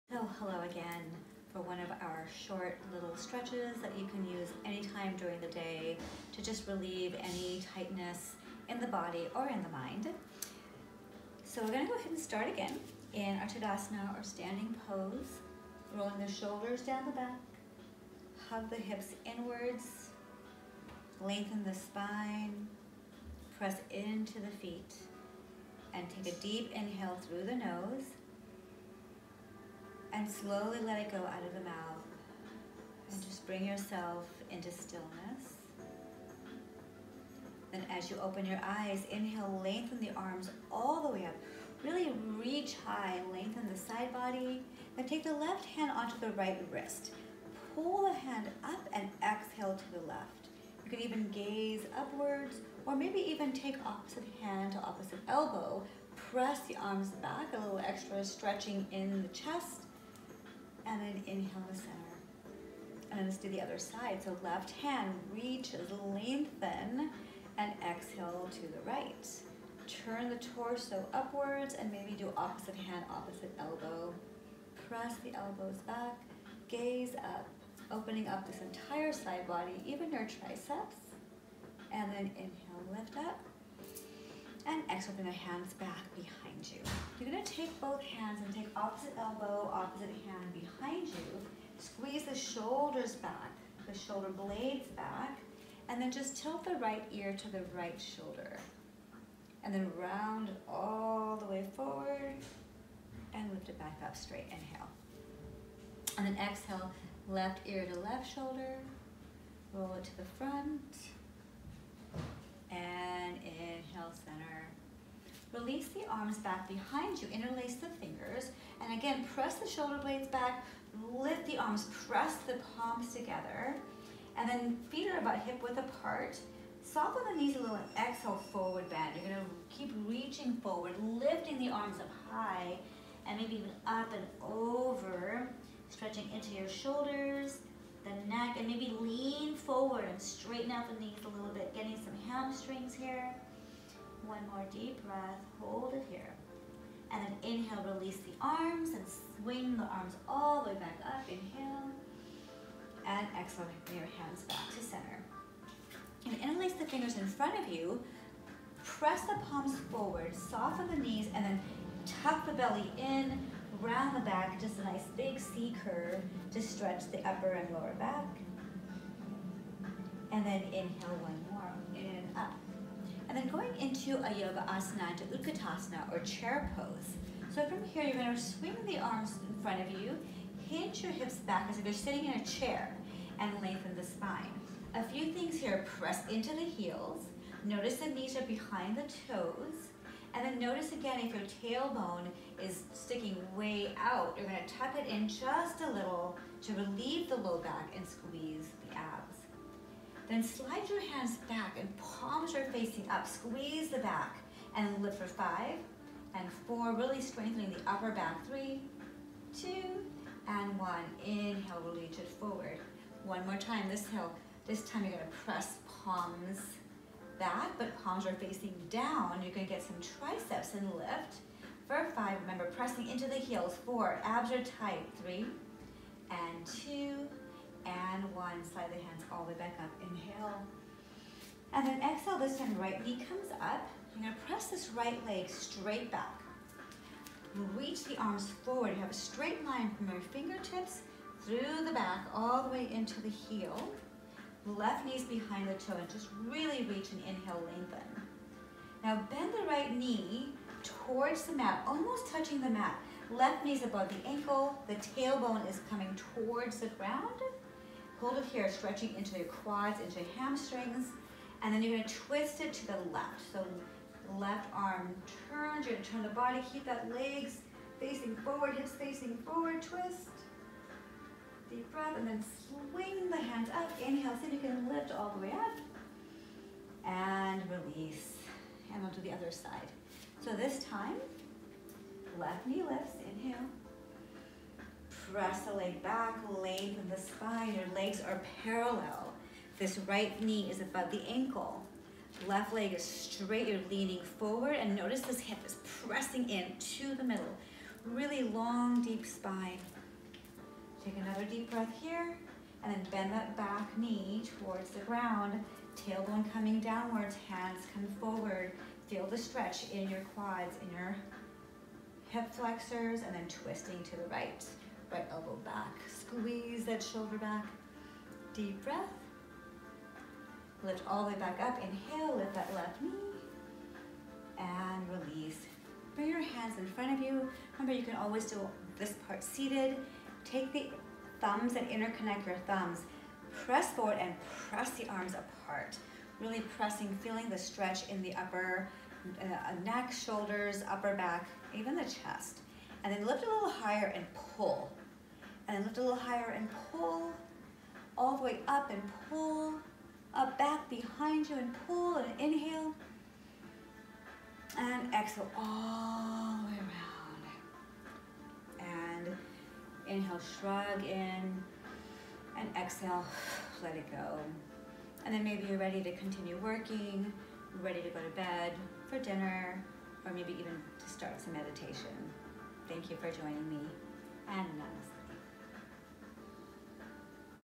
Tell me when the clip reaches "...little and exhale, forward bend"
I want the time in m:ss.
2:07.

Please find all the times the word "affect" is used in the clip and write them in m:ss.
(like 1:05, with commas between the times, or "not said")
not said.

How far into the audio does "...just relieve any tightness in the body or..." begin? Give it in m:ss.
0:06.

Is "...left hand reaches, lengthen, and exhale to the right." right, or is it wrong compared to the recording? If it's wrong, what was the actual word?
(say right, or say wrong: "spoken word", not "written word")
right.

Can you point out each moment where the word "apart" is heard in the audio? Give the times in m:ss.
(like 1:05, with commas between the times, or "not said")
2:05, 5:35.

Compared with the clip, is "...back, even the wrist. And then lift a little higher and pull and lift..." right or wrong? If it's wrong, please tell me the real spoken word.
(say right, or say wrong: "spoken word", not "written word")
wrong: "chest", not "wrist".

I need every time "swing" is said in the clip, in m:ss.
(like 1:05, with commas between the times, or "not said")
2:29, 2:58, 4:32.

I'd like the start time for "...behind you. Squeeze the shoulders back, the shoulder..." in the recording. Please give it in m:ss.
1:30.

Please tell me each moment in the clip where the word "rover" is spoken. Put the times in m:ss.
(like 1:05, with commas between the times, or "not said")
not said.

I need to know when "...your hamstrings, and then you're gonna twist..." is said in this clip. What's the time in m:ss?
4:20.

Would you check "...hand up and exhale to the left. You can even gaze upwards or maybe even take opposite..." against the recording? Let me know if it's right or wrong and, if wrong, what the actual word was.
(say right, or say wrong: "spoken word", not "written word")
right.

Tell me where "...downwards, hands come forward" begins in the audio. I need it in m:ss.
5:06.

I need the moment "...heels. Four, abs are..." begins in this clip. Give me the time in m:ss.
3:43.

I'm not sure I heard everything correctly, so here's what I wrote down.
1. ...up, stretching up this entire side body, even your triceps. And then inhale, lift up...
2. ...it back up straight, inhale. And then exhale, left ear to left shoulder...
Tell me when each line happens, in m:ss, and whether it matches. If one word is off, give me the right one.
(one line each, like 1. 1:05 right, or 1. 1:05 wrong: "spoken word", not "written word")
1. 1:17 wrong: "opening", not "stretching"
2. 1:43 right.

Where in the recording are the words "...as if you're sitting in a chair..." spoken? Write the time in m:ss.
3:01.